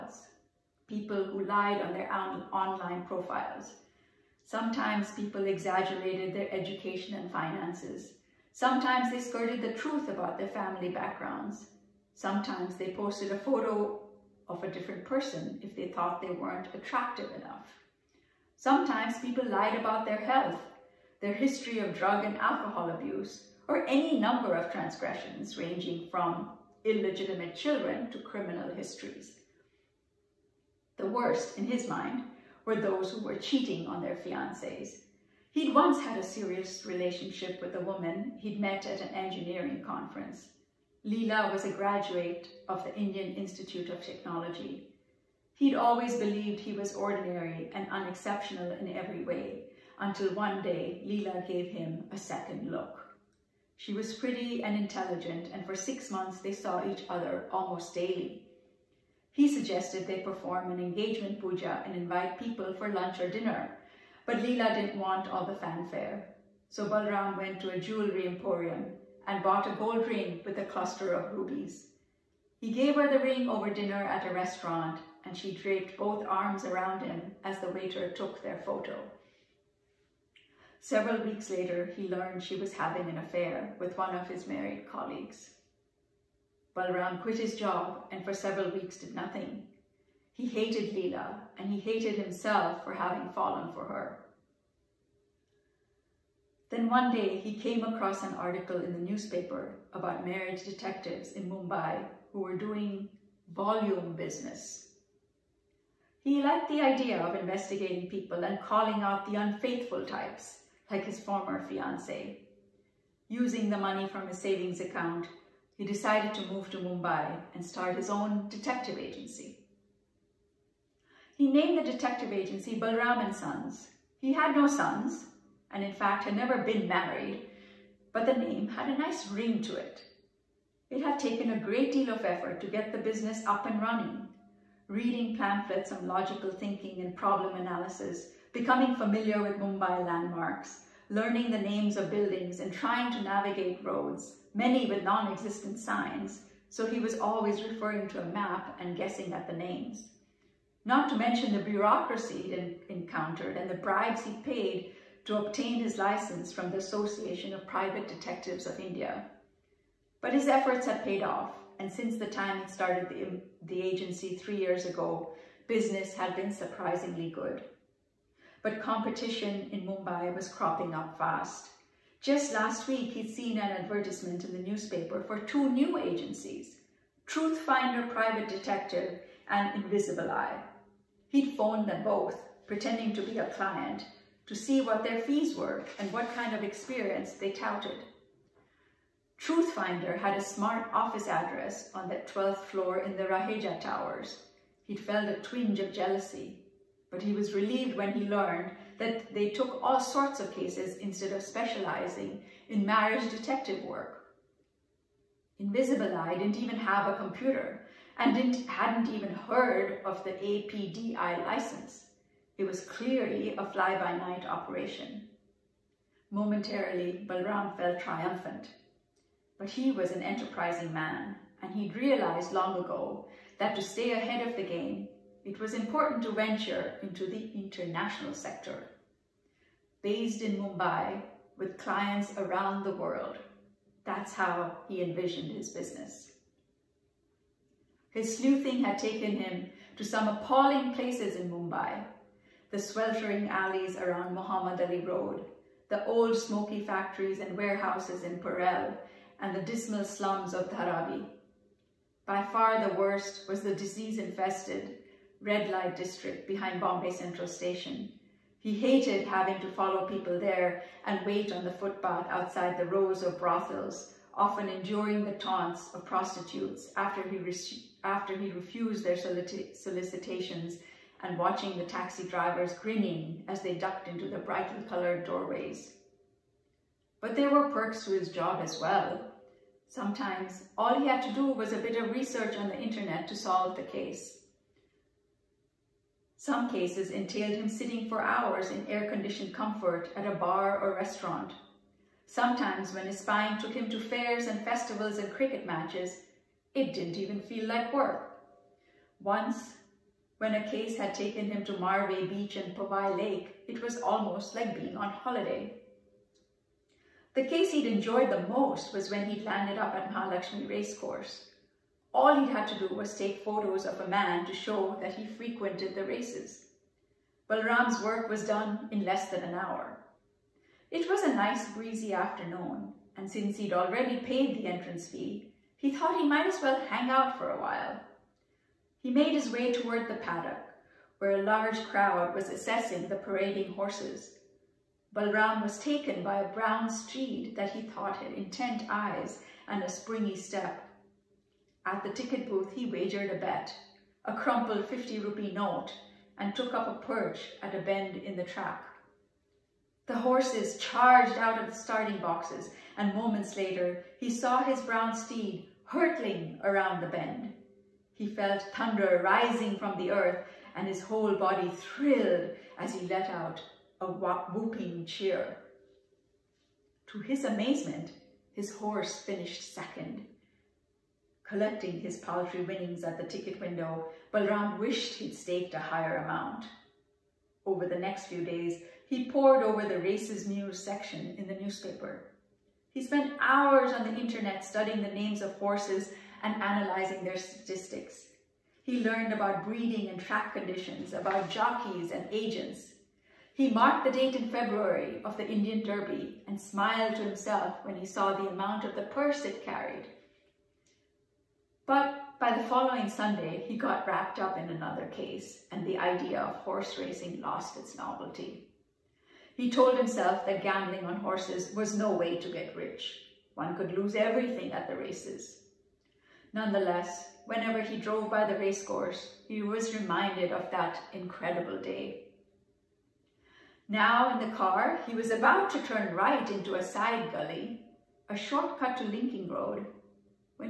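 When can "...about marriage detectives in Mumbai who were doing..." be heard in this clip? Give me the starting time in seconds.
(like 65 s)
99 s.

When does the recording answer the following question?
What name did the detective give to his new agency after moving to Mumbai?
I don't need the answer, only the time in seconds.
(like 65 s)
122 s.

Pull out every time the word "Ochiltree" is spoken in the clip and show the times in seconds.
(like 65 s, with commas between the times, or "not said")
not said.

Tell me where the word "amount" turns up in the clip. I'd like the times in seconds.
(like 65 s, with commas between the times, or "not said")
376 s, 398 s.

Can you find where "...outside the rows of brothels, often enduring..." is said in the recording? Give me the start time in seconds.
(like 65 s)
262 s.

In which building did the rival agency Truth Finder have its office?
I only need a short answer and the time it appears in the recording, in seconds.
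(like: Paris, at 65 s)
Raheja Towers, at 193 s.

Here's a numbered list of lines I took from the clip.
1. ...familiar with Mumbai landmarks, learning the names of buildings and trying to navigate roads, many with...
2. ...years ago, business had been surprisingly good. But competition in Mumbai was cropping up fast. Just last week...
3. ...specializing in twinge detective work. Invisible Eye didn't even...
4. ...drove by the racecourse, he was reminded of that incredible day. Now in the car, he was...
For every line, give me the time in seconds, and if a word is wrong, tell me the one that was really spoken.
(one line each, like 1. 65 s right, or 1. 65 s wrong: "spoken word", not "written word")
1. 138 s right
2. 164 s right
3. 201 s wrong: "marriage", not "twinge"
4. 417 s right.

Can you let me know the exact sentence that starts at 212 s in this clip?
It was clearly a fly-by-night operation.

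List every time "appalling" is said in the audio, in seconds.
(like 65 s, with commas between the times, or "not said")
240 s.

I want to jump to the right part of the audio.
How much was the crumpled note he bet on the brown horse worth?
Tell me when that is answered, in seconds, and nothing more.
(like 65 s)
344 s.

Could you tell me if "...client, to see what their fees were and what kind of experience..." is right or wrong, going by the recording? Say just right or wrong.
right.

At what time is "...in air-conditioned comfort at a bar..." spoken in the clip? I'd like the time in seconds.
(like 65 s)
288 s.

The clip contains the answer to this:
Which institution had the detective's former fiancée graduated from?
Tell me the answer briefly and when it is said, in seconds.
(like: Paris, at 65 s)
Indian Institute of Technology, at 42 s.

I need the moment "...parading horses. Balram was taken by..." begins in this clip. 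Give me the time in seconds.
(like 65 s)
333 s.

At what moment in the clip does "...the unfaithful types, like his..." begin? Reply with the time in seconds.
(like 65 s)
109 s.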